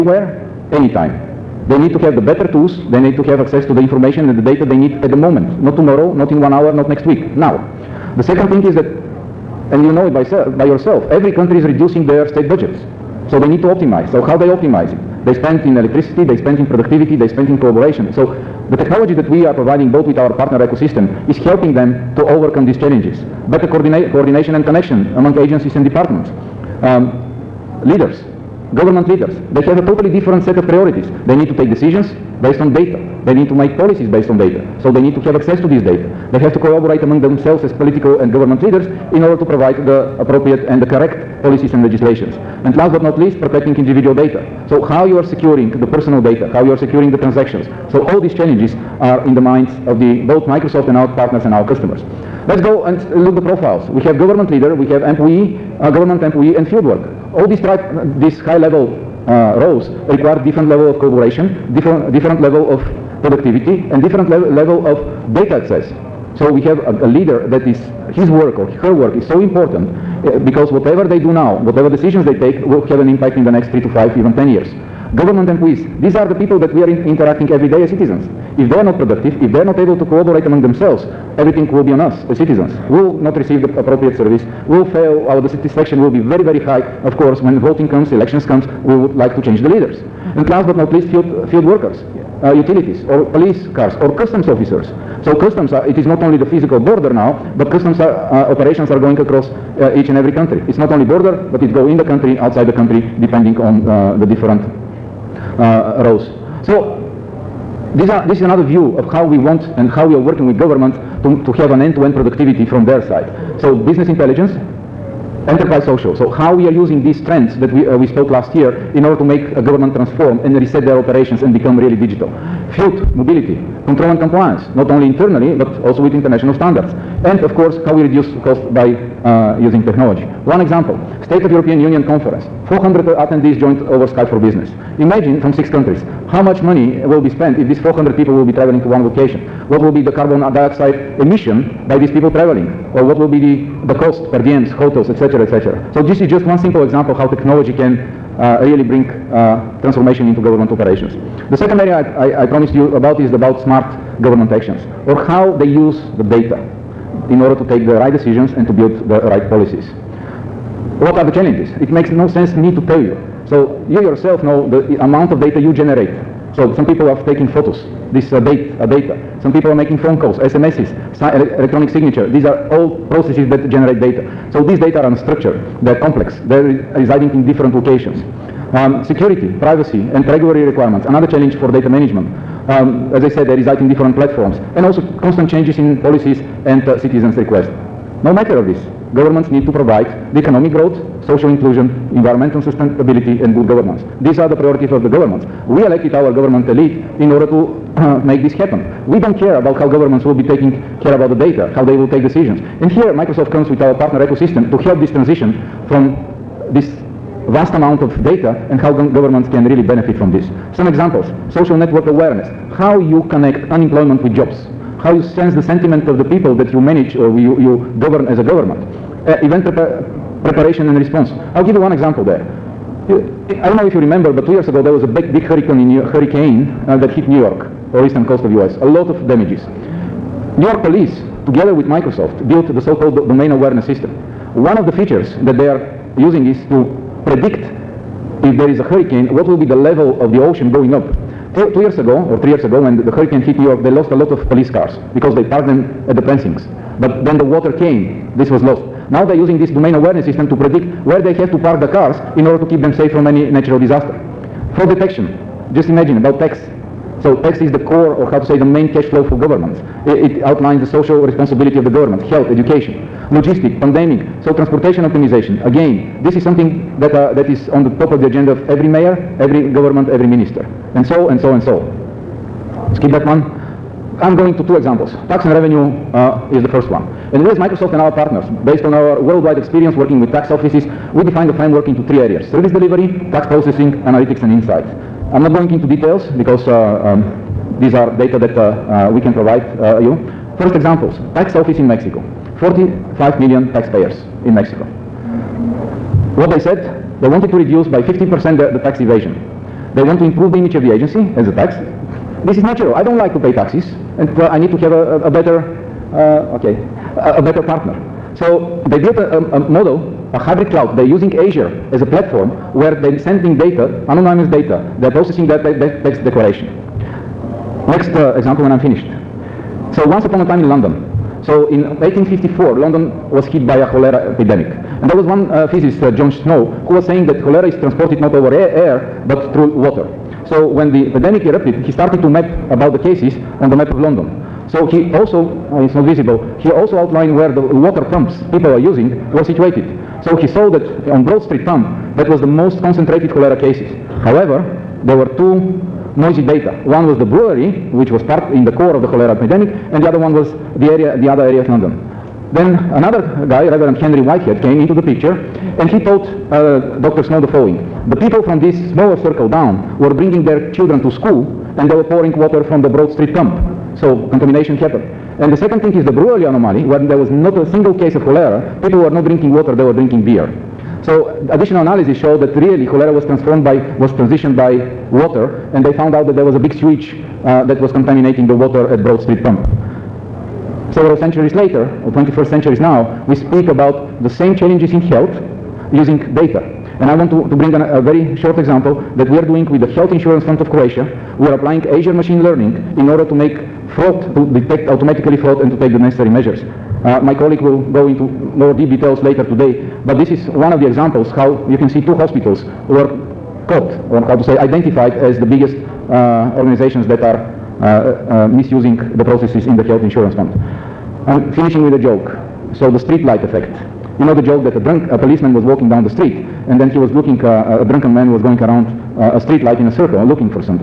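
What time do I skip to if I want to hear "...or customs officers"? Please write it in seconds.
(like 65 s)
94 s.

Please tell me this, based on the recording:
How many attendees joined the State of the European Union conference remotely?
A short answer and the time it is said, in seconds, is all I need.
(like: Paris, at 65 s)
400, at 132 s.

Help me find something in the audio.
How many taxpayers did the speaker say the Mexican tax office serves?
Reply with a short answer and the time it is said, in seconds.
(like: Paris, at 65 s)
45 million, at 292 s.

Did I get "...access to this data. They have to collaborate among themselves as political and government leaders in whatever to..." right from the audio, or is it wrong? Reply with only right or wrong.
wrong.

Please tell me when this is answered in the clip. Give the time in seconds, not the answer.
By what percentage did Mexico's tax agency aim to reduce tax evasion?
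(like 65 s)
298 s.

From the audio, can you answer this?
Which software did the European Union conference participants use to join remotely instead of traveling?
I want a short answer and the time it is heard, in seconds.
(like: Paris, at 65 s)
Skype for Business, at 134 s.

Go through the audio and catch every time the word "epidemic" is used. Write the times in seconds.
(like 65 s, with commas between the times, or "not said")
324 s, 331 s, 349 s.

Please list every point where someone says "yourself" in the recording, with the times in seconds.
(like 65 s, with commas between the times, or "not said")
10 s, 164 s.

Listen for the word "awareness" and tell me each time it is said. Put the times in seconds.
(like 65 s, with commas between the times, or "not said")
212 s, 233 s, 249 s.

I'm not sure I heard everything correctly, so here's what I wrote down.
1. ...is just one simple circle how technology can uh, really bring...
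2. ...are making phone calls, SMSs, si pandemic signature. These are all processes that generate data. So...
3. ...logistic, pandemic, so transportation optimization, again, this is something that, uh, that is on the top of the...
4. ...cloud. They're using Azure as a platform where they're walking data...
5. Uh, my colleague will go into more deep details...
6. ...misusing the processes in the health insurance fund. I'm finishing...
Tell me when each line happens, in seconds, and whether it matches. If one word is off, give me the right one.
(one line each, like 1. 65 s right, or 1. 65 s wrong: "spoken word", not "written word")
1. 146 s wrong: "example", not "circle"
2. 169 s wrong: "electronic", not "pandemic"
3. 263 s right
4. 310 s wrong: "sending", not "walking"
5. 397 s right
6. 408 s right.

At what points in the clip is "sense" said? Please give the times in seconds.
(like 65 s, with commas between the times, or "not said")
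162 s, 215 s.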